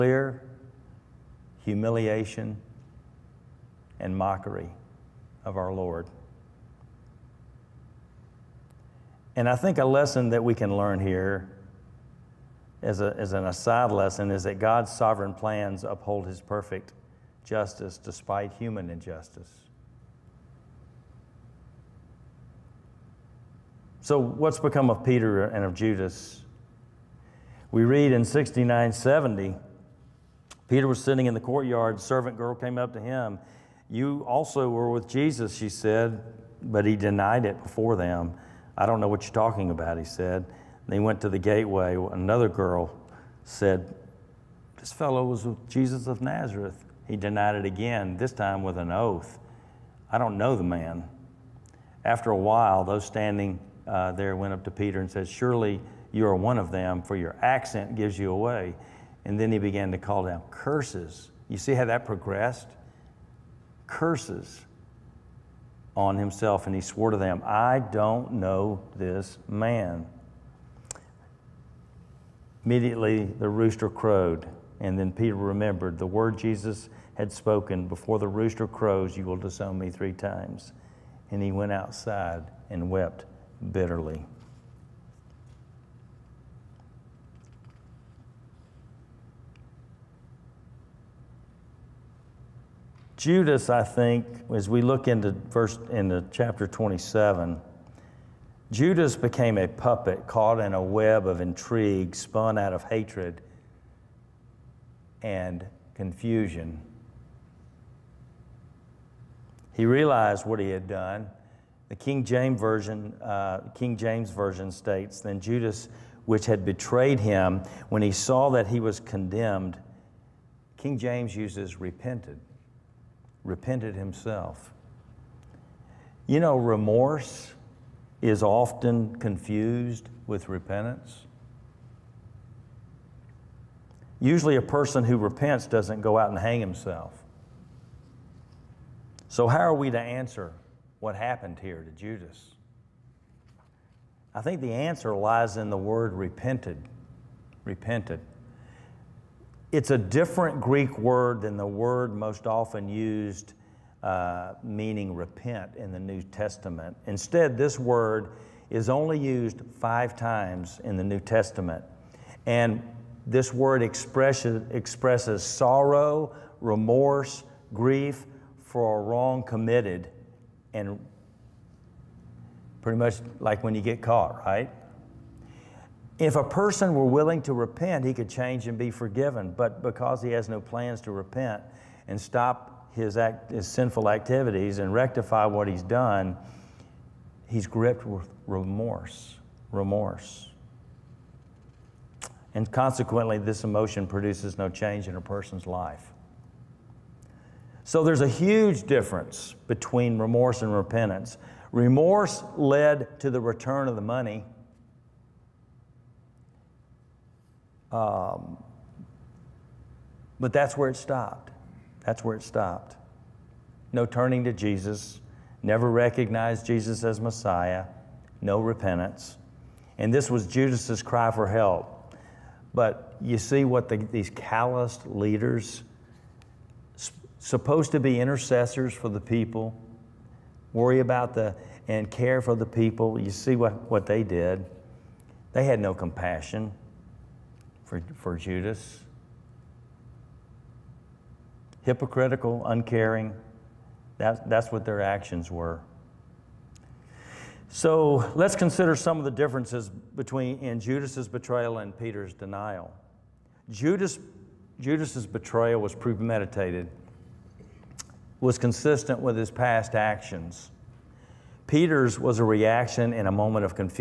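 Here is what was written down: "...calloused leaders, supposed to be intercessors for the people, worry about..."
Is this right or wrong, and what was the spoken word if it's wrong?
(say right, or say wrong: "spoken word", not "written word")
right.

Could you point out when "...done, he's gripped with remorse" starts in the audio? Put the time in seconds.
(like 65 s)
185 s.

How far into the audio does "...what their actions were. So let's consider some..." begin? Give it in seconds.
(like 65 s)
244 s.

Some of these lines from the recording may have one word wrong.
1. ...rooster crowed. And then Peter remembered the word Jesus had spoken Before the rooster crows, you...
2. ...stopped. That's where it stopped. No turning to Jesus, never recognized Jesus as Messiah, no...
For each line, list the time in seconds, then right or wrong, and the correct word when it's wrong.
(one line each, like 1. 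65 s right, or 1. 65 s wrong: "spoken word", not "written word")
1. 73 s right
2. 210 s right.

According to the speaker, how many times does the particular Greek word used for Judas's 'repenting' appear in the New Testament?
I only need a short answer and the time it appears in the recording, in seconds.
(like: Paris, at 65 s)
5, at 159 s.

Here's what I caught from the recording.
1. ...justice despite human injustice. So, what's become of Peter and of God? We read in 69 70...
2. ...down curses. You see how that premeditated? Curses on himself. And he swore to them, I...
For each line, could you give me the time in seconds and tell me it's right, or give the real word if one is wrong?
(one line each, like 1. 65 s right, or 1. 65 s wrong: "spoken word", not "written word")
1. 17 s wrong: "Judas", not "God"
2. 60 s wrong: "progressed", not "premeditated".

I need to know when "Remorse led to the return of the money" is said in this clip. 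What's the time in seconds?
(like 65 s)
201 s.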